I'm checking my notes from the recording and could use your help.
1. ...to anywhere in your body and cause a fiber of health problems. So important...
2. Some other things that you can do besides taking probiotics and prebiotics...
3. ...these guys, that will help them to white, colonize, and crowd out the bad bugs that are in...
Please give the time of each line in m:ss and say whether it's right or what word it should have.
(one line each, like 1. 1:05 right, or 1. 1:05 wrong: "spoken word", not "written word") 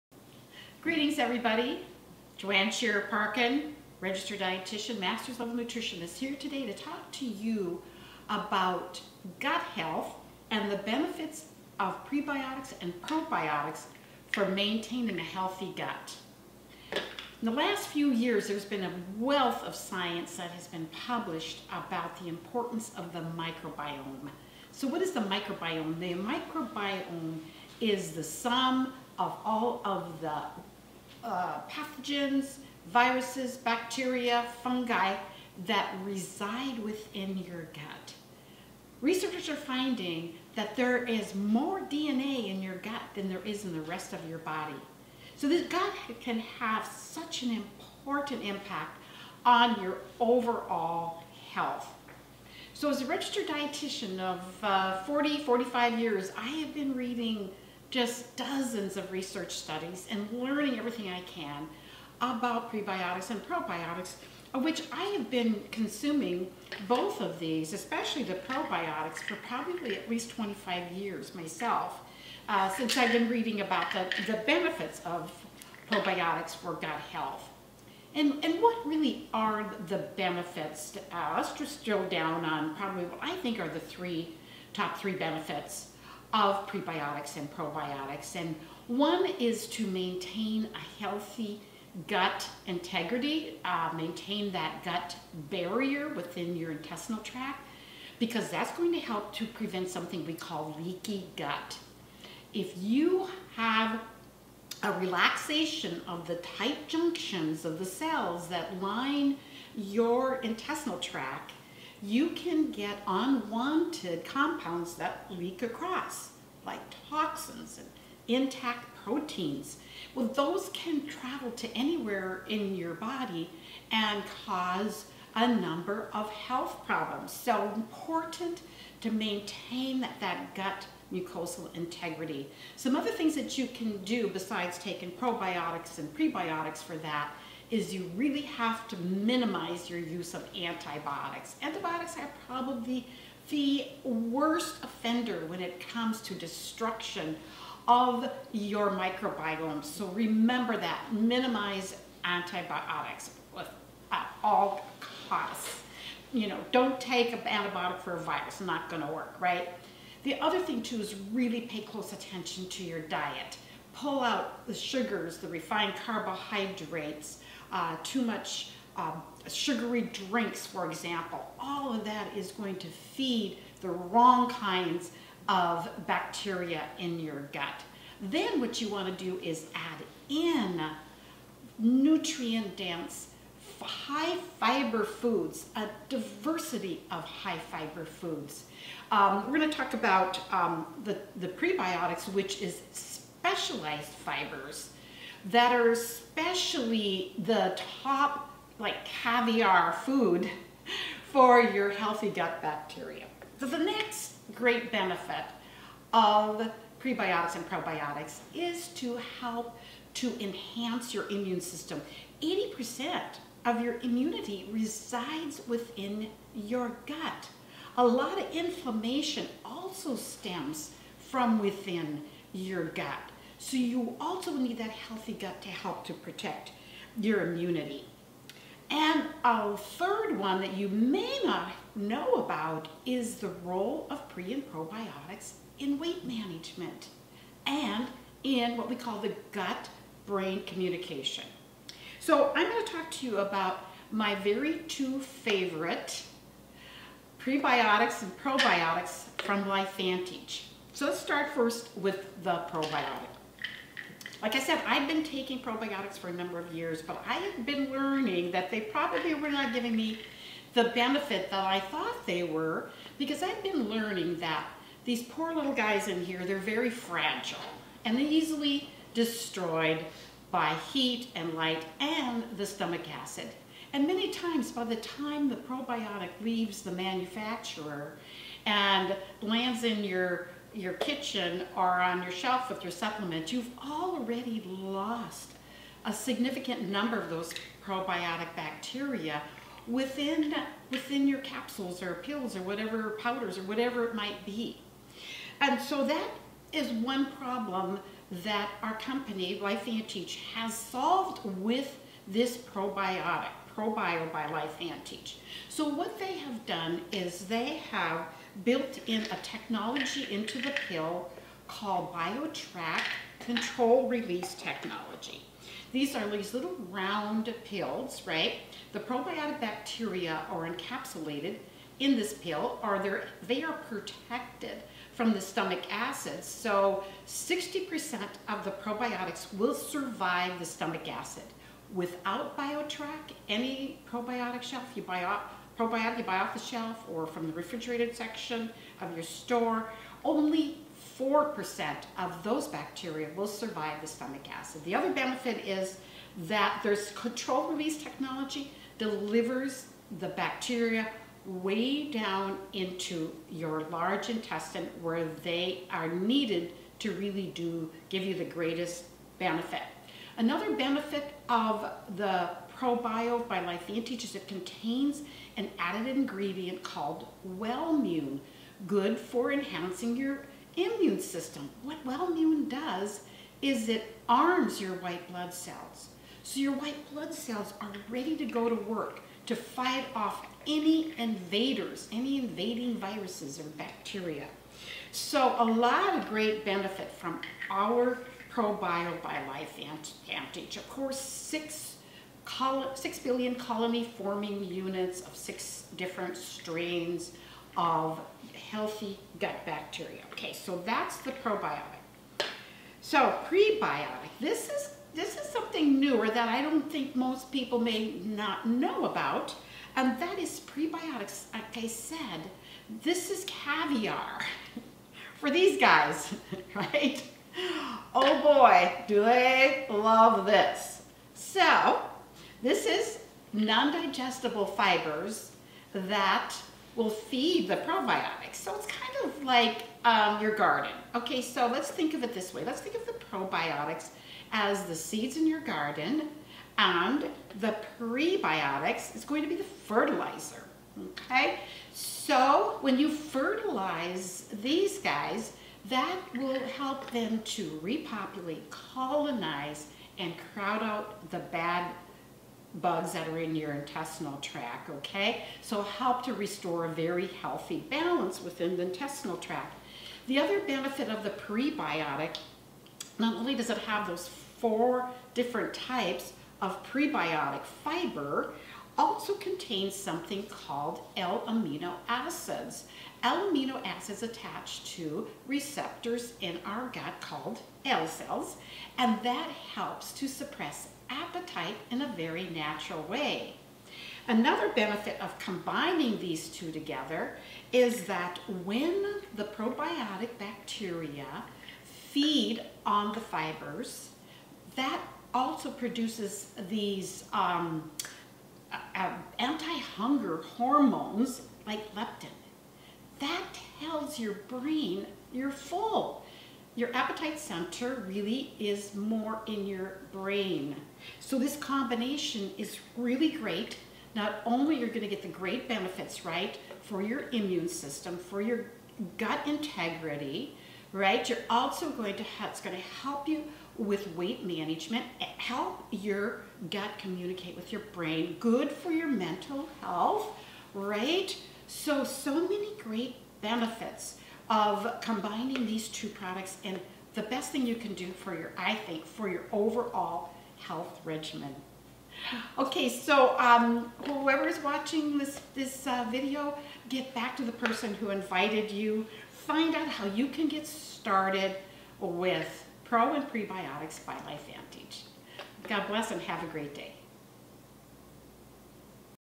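1. 2:01 wrong: "number", not "fiber"
2. 2:12 right
3. 7:24 wrong: "repopulate", not "white".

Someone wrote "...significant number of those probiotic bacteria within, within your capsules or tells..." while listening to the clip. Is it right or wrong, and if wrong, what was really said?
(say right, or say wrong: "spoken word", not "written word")
wrong: "pills", not "tells".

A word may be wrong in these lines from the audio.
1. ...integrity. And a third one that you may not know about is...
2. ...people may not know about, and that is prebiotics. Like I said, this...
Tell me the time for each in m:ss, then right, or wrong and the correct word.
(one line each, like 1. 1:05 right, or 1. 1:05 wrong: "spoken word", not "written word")
1. 3:47 wrong: "immunity", not "integrity"
2. 6:47 right.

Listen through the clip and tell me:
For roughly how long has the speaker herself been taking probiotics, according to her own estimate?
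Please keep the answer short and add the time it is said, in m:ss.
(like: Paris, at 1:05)
25 years, at 1:10.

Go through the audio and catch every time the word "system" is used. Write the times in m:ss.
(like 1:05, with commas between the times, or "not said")
3:31, 6:11, 8:37.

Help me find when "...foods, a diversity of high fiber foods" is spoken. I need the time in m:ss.
3:05.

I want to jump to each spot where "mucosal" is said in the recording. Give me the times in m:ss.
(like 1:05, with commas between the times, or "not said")
2:11.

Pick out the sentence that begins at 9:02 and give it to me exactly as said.
Okay, so um, whoever's watching this, this uh, video, get back to the person who invited you.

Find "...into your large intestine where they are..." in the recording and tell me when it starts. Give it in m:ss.
5:52.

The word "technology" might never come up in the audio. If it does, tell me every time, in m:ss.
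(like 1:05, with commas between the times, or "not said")
5:09, 5:14, 5:48.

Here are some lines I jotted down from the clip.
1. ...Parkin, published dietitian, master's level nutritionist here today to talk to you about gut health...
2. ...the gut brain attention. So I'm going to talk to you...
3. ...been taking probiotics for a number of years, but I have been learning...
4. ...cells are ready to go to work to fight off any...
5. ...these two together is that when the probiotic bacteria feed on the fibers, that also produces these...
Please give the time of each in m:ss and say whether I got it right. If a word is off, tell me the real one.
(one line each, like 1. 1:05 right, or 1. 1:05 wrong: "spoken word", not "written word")
1. 0:03 wrong: "registered", not "published"
2. 3:59 wrong: "communication", not "attention"
3. 4:15 right
4. 6:17 right
5. 8:06 right.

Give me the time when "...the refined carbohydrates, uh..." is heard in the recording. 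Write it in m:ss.
2:45.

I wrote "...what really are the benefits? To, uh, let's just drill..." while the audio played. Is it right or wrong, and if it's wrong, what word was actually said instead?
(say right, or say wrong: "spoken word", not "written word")
right.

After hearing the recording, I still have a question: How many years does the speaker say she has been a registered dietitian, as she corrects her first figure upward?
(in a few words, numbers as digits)
45.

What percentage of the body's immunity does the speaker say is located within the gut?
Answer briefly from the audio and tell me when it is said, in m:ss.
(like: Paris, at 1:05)
80%, at 3:32.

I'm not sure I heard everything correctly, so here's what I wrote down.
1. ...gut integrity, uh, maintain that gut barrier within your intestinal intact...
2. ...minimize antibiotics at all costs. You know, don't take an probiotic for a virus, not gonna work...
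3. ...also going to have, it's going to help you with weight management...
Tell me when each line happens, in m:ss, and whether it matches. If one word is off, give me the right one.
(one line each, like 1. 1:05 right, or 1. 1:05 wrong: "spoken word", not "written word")
1. 1:32 wrong: "tract", not "intact"
2. 2:31 wrong: "antibiotic", not "probiotic"
3. 8:41 right.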